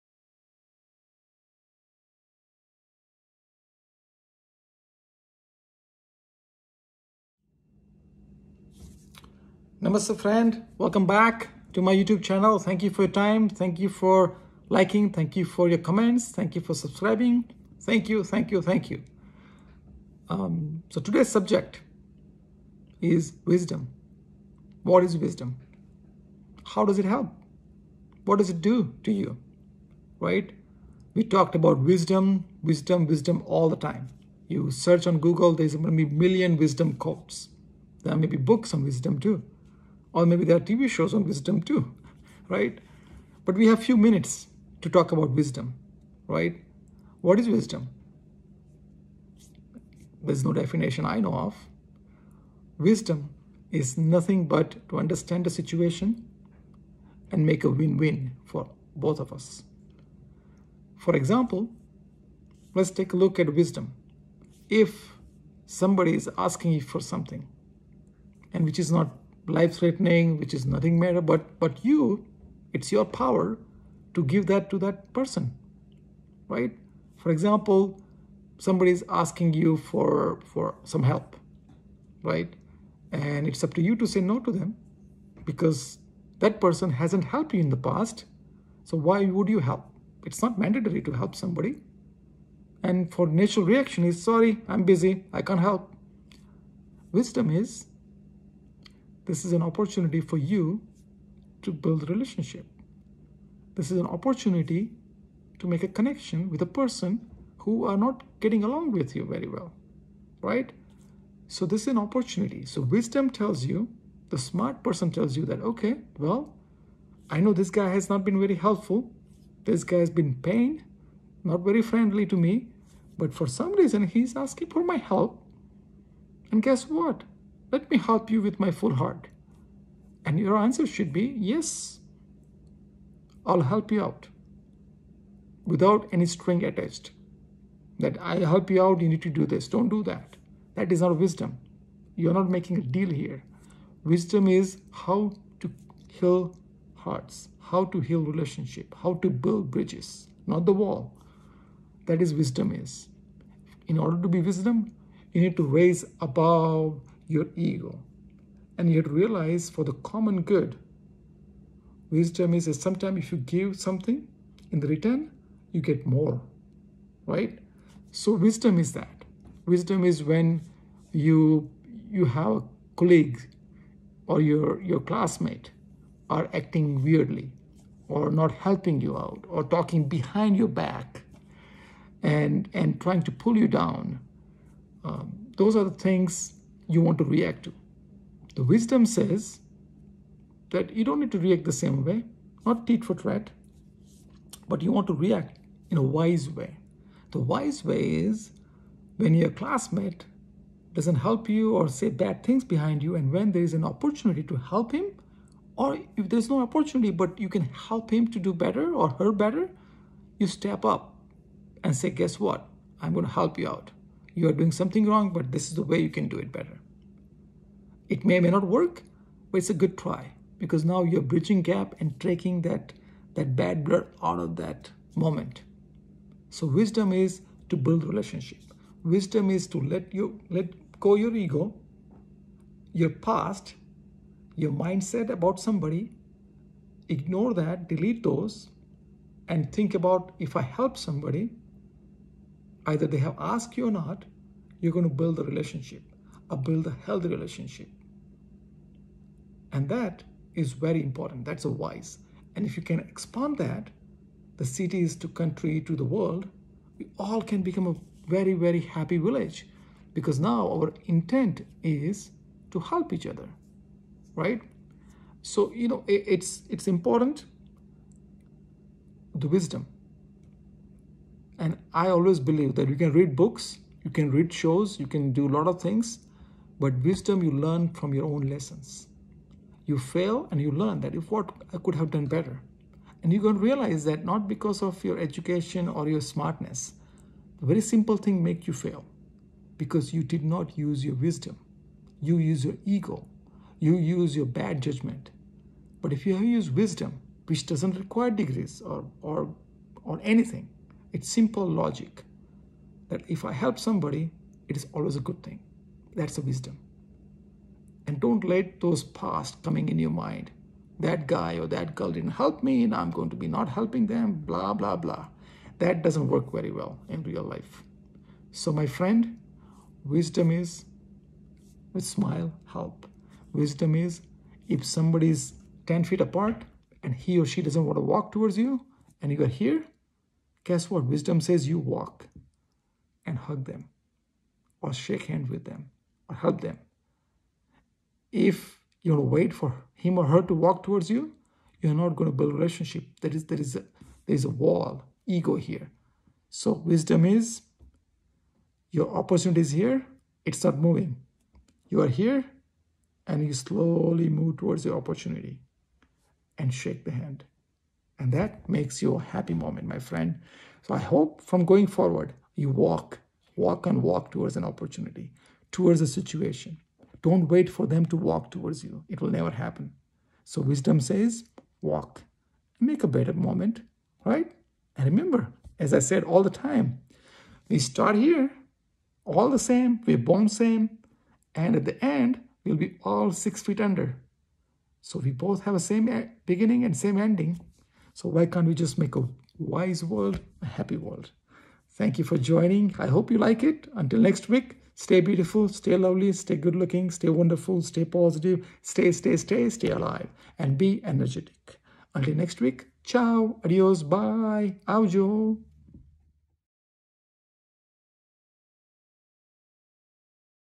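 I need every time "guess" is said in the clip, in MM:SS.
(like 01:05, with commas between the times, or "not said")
02:06, 03:32, 05:30.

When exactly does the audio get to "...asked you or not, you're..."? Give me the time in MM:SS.
04:03.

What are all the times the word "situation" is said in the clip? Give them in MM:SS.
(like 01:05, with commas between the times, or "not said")
00:55, 06:06.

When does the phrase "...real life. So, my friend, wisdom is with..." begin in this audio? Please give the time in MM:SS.
05:17.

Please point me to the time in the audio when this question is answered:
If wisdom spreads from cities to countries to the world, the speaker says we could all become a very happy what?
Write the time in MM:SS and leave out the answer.
04:19.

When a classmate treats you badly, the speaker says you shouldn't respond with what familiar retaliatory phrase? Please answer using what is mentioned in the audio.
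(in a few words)
tit for tat.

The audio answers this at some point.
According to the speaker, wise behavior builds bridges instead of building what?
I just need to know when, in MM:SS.
02:30.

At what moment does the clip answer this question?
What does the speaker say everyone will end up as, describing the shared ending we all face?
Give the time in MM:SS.
06:23.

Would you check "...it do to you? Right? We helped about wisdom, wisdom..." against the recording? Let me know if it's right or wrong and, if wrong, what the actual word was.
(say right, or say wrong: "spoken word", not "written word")
wrong: "talked", not "helped".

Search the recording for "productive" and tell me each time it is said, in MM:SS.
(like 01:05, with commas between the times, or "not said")
not said.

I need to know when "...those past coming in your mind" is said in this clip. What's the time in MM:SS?
05:08.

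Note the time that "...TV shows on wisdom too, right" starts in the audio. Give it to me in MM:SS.
00:40.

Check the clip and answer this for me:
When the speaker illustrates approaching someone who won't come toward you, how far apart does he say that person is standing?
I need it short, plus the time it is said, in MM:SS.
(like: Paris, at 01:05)
10 feet, at 05:25.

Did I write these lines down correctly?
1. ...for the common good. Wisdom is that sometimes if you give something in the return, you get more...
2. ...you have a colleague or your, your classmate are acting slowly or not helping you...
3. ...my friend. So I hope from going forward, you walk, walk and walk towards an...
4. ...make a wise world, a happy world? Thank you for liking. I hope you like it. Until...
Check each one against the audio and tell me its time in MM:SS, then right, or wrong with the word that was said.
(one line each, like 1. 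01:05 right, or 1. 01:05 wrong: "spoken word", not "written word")
1. 02:39 right
2. 02:52 wrong: "weirdly", not "slowly"
3. 05:59 right
4. 06:28 wrong: "joining", not "liking".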